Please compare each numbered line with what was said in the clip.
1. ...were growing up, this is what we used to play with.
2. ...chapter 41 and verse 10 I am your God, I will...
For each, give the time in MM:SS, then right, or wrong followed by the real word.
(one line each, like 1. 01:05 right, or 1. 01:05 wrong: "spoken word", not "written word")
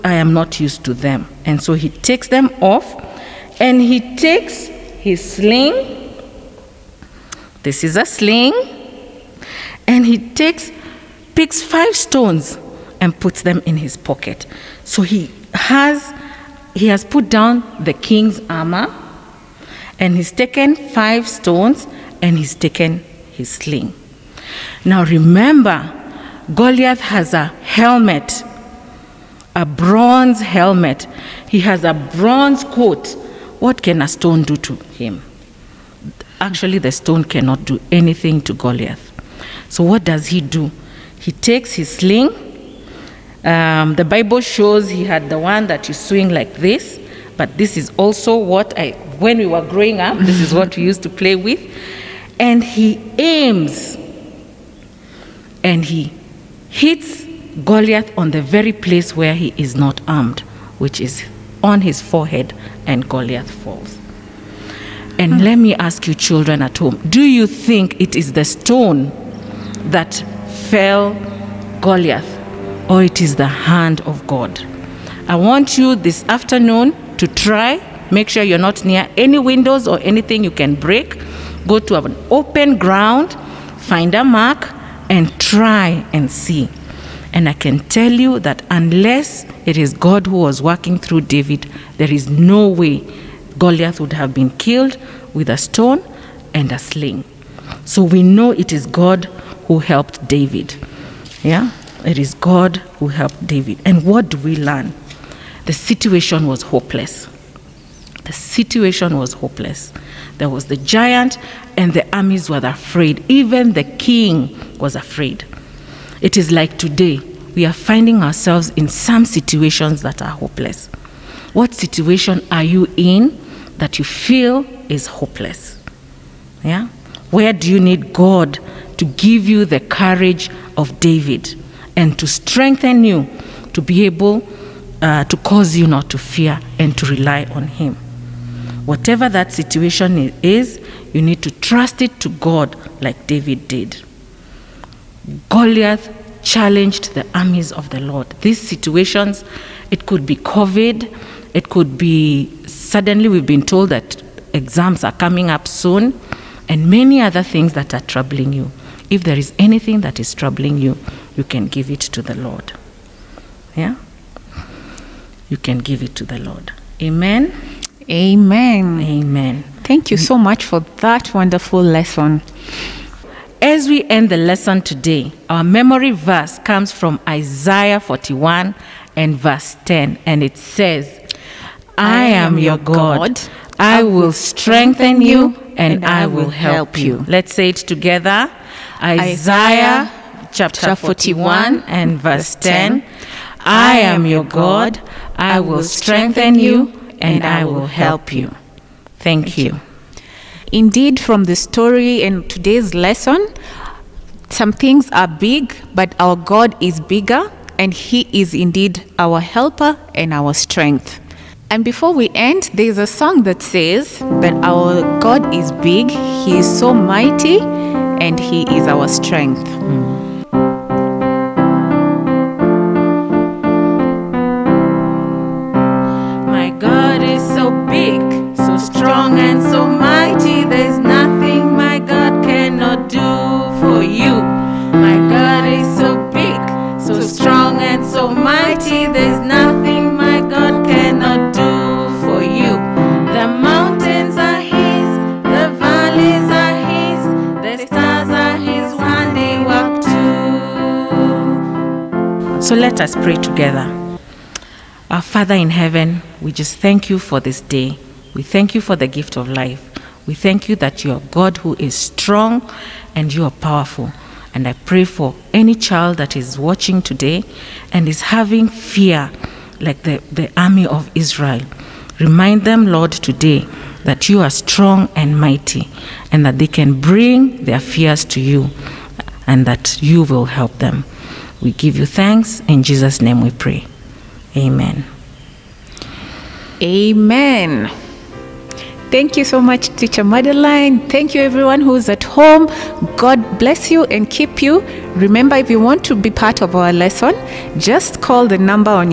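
1. 00:49 right
2. 03:10 right.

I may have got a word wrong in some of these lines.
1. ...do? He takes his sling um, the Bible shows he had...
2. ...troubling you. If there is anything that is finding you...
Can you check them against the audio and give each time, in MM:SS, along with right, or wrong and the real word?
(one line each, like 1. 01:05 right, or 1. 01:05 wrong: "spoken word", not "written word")
1. 00:40 right
2. 02:38 wrong: "troubling", not "finding".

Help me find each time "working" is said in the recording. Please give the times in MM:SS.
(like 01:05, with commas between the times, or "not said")
01:30.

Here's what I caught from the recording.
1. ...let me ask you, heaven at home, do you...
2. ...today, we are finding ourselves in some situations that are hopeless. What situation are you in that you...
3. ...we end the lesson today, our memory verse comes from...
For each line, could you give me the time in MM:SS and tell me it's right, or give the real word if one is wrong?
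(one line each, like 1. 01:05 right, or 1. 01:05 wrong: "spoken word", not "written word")
1. 01:05 wrong: "children", not "heaven"
2. 01:56 right
3. 02:53 right.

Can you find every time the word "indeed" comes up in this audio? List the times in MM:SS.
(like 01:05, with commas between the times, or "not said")
03:20, 03:28.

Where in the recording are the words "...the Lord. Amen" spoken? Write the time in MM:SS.
02:46.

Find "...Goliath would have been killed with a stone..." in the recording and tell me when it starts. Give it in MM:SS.
01:33.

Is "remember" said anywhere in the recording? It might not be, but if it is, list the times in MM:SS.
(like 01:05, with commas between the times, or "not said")
00:25, 04:55.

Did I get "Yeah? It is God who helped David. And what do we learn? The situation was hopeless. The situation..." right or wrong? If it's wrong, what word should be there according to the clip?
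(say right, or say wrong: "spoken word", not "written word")
right.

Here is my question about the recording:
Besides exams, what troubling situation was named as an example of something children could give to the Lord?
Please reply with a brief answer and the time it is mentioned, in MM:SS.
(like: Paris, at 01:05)
COVID, at 02:30.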